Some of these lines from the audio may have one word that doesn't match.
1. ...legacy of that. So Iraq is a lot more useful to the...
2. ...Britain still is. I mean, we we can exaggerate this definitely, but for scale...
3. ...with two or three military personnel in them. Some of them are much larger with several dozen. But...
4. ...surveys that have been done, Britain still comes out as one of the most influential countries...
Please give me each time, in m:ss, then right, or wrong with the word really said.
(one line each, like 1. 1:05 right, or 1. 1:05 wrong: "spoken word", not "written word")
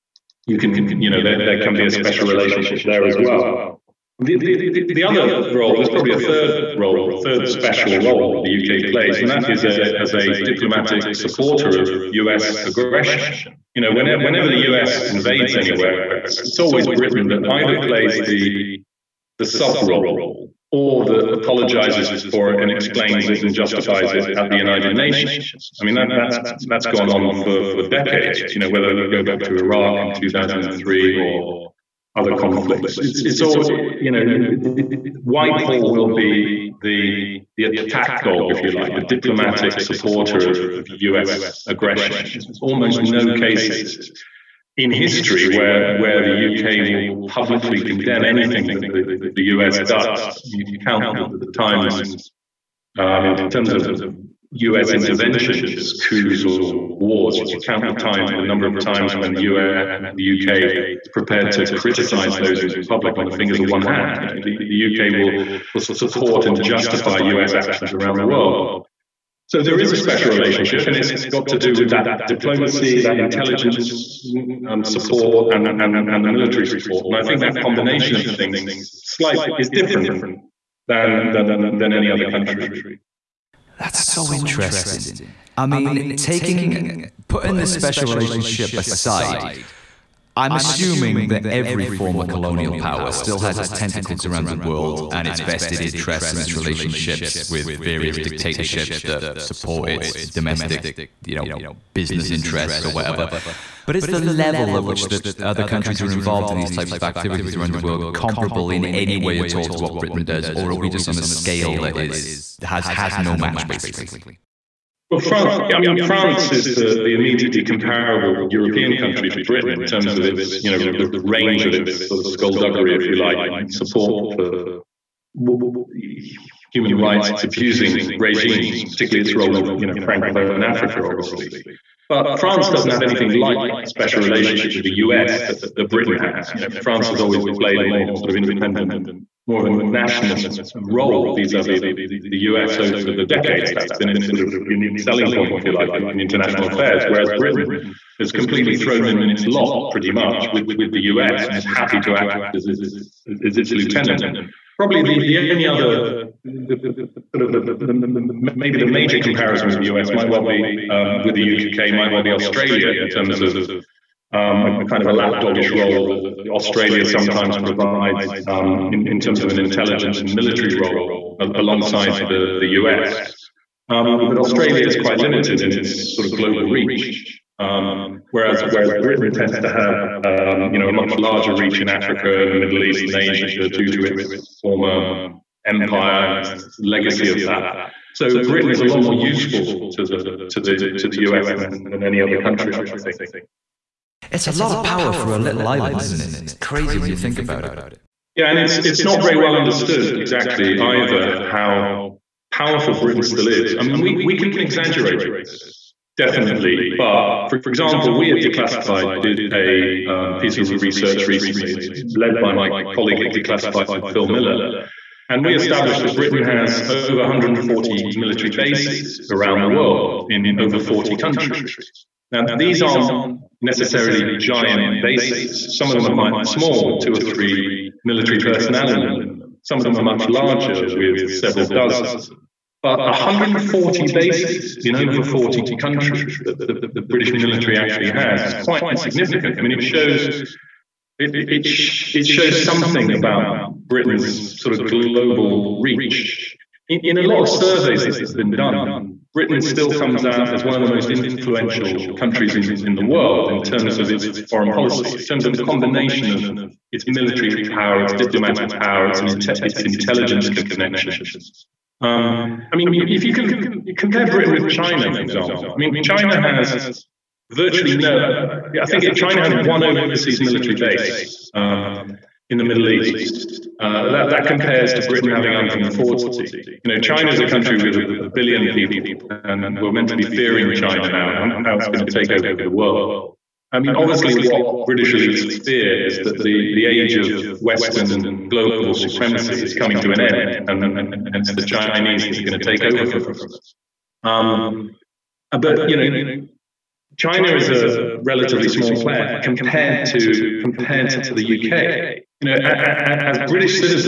1. 3:06 wrong: "Britain", not "Iraq"
2. 3:22 wrong: "example", not "scale"
3. 3:46 right
4. 4:07 right.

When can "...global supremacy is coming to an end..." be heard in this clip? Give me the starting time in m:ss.
4:48.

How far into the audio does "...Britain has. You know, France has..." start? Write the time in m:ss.
2:15.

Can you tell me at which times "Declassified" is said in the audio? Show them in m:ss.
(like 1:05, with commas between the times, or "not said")
3:28, 3:33.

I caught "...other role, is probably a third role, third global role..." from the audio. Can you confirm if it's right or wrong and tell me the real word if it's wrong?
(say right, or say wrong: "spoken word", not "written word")
wrong: "special", not "global".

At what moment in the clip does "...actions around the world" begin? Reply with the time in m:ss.
1:07.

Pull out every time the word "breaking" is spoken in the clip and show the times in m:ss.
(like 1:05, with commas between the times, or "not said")
not said.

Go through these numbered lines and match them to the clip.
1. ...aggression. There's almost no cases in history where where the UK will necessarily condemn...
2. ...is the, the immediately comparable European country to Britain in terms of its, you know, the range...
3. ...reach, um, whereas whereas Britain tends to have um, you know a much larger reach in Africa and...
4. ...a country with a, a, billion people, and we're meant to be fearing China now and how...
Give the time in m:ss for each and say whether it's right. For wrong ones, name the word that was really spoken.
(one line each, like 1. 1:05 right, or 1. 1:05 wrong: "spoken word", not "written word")
1. 0:41 wrong: "publicly", not "necessarily"
2. 1:56 right
3. 2:56 right
4. 4:37 right.